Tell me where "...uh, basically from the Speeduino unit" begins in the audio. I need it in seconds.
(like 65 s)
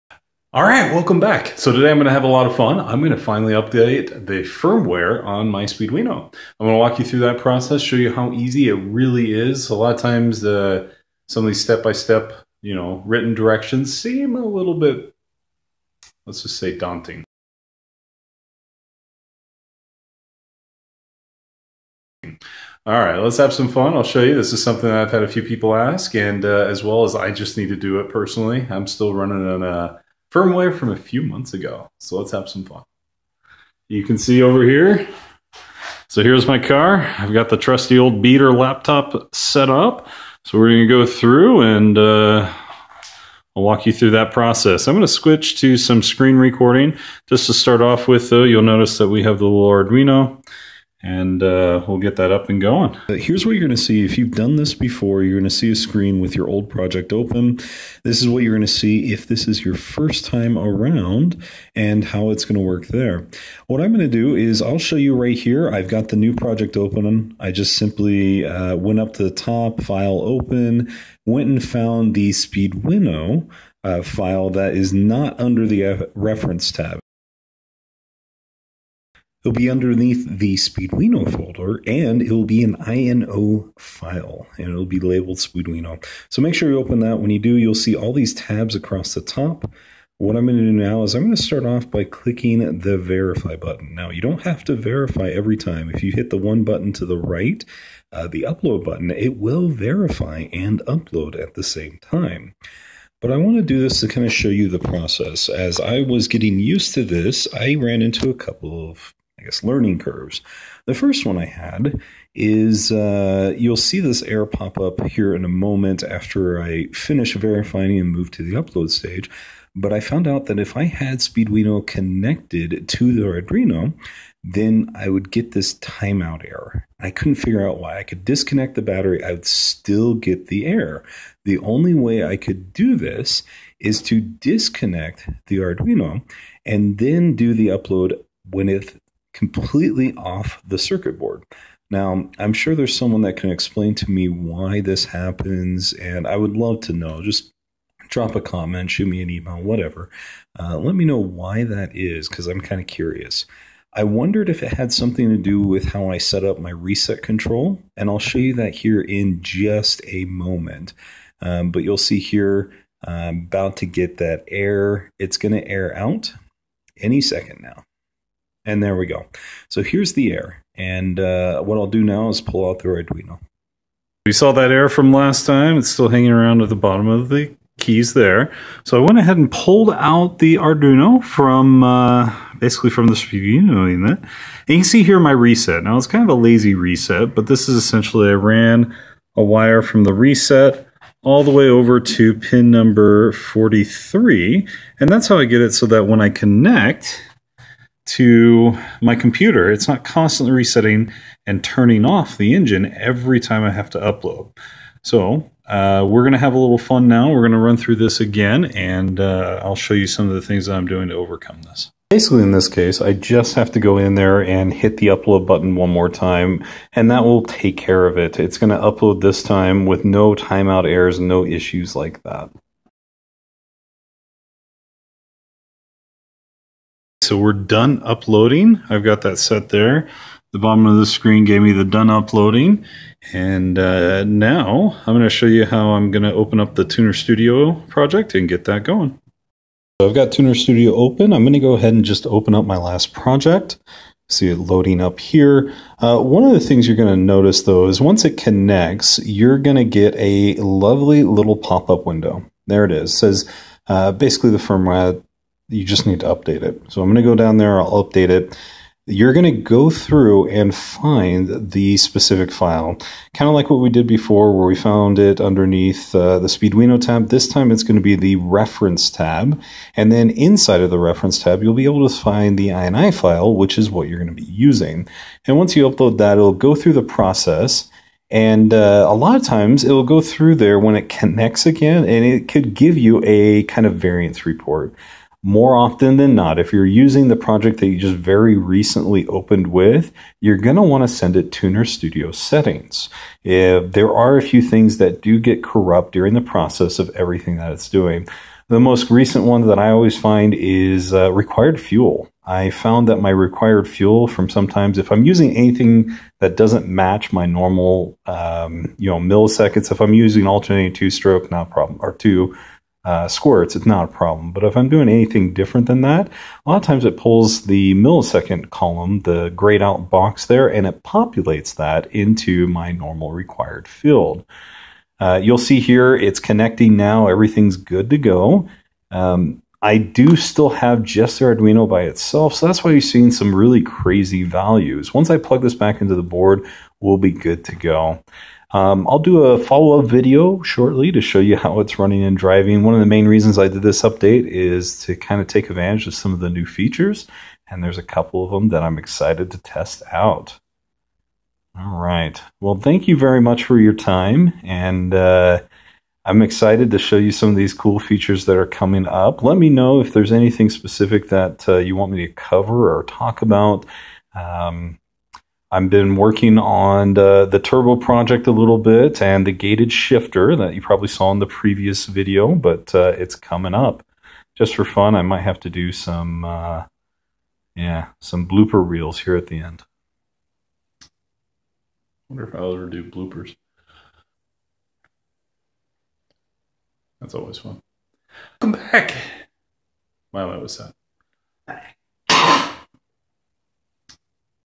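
181 s.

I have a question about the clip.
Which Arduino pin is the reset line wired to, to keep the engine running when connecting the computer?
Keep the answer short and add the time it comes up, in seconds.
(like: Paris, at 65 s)
43, at 192 s.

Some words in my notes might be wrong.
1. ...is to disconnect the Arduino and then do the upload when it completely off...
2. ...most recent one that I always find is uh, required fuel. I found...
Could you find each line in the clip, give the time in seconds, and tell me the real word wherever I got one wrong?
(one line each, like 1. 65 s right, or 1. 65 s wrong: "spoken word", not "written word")
1. 133 s right
2. 298 s right.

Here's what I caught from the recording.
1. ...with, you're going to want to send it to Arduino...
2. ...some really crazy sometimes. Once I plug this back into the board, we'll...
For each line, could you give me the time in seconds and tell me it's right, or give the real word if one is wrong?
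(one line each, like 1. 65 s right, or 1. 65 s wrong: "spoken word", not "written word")
1. 289 s wrong: "Tuner", not "Arduino"
2. 333 s wrong: "values", not "sometimes".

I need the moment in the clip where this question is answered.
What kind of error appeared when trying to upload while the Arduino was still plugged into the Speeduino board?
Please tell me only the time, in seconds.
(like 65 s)
125 s.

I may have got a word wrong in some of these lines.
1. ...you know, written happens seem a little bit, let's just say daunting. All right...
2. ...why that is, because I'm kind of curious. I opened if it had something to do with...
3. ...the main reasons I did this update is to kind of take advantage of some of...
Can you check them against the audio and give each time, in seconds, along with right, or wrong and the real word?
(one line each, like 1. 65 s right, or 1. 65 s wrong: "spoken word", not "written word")
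1. 12 s wrong: "directions", not "happens"
2. 151 s wrong: "wondered", not "opened"
3. 343 s right.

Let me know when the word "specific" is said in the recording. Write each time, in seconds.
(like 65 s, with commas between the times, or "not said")
261 s, 360 s.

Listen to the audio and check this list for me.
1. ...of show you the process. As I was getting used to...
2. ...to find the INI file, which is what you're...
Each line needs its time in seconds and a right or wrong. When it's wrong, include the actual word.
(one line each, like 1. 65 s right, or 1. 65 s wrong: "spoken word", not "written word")
1. 104 s right
2. 272 s right.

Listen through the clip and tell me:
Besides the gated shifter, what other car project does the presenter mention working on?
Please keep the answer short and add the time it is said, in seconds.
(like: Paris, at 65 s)
turbo project, at 367 s.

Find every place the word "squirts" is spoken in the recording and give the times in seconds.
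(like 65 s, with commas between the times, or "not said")
313 s.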